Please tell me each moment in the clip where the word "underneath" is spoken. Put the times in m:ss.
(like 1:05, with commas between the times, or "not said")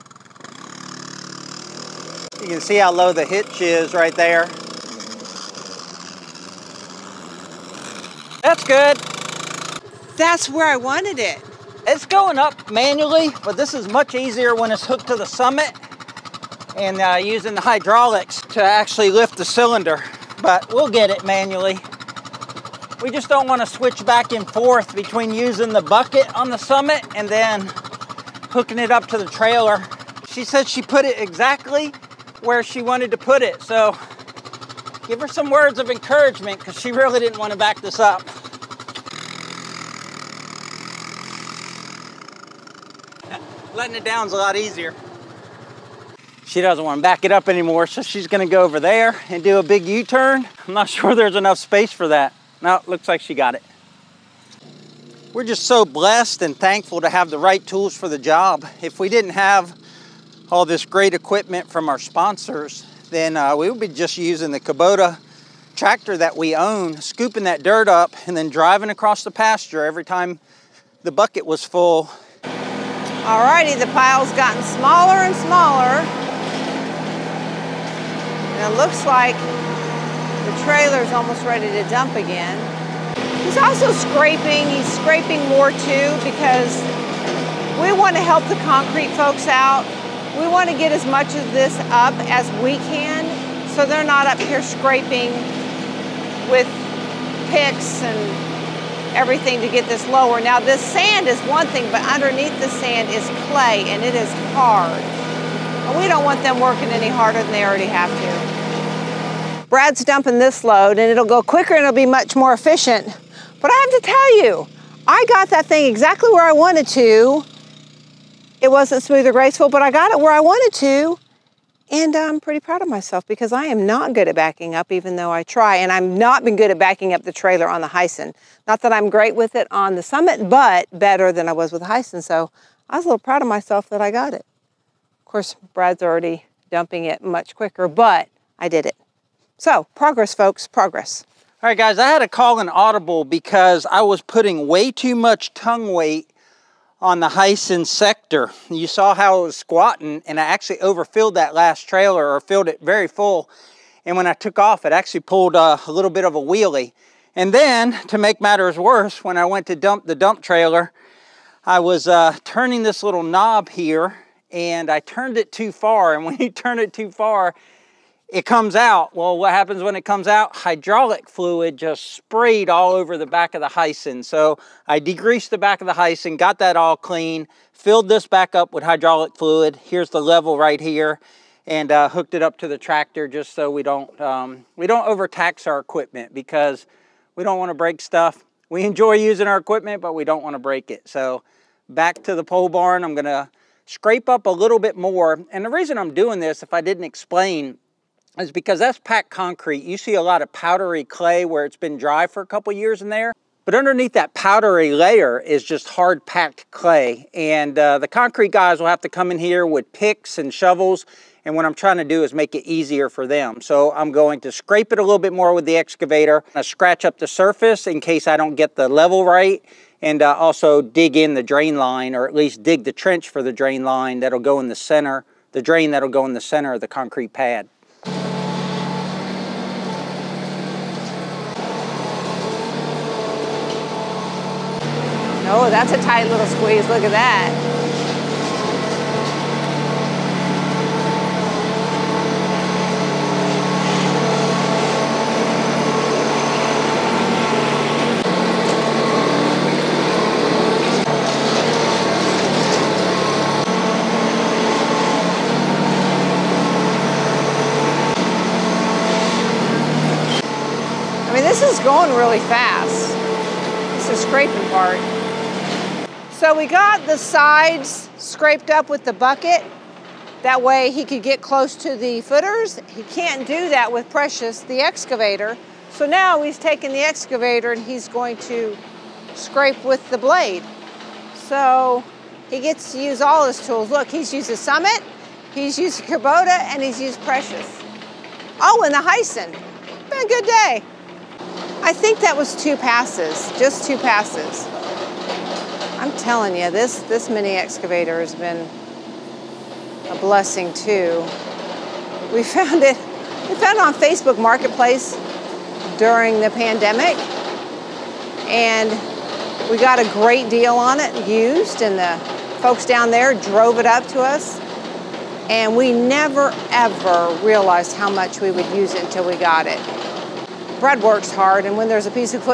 1:42, 3:23.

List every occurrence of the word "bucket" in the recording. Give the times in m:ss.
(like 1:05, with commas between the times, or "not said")
0:25, 1:11, 4:29.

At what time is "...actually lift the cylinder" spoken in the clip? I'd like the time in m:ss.
0:18.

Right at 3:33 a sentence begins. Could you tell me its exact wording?
So I'm going to scrape it a little bit more with the excavator.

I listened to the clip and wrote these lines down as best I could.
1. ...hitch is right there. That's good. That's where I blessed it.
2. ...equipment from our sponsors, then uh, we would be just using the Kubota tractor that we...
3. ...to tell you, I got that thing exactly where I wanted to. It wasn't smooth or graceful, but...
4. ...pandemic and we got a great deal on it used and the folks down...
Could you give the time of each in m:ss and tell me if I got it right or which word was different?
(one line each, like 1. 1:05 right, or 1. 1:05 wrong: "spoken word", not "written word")
1. 0:03 wrong: "wanted", not "blessed"
2. 1:01 right
3. 1:54 right
4. 5:06 right.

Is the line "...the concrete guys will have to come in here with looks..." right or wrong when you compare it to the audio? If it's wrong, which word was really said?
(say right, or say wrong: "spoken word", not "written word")
wrong: "picks", not "looks".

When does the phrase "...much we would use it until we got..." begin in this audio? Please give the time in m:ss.
5:18.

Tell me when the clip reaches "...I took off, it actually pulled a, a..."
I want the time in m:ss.
2:34.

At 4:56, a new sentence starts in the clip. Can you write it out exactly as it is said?
I'm telling you, this, this mini excavator has been a blessing too.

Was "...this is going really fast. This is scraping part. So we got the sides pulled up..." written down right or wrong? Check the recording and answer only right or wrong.
wrong.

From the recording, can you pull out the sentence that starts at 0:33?
So give her some words of encouragement because she really didn't want to back this up.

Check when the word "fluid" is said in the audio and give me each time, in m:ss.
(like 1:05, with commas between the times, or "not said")
2:51, 2:59.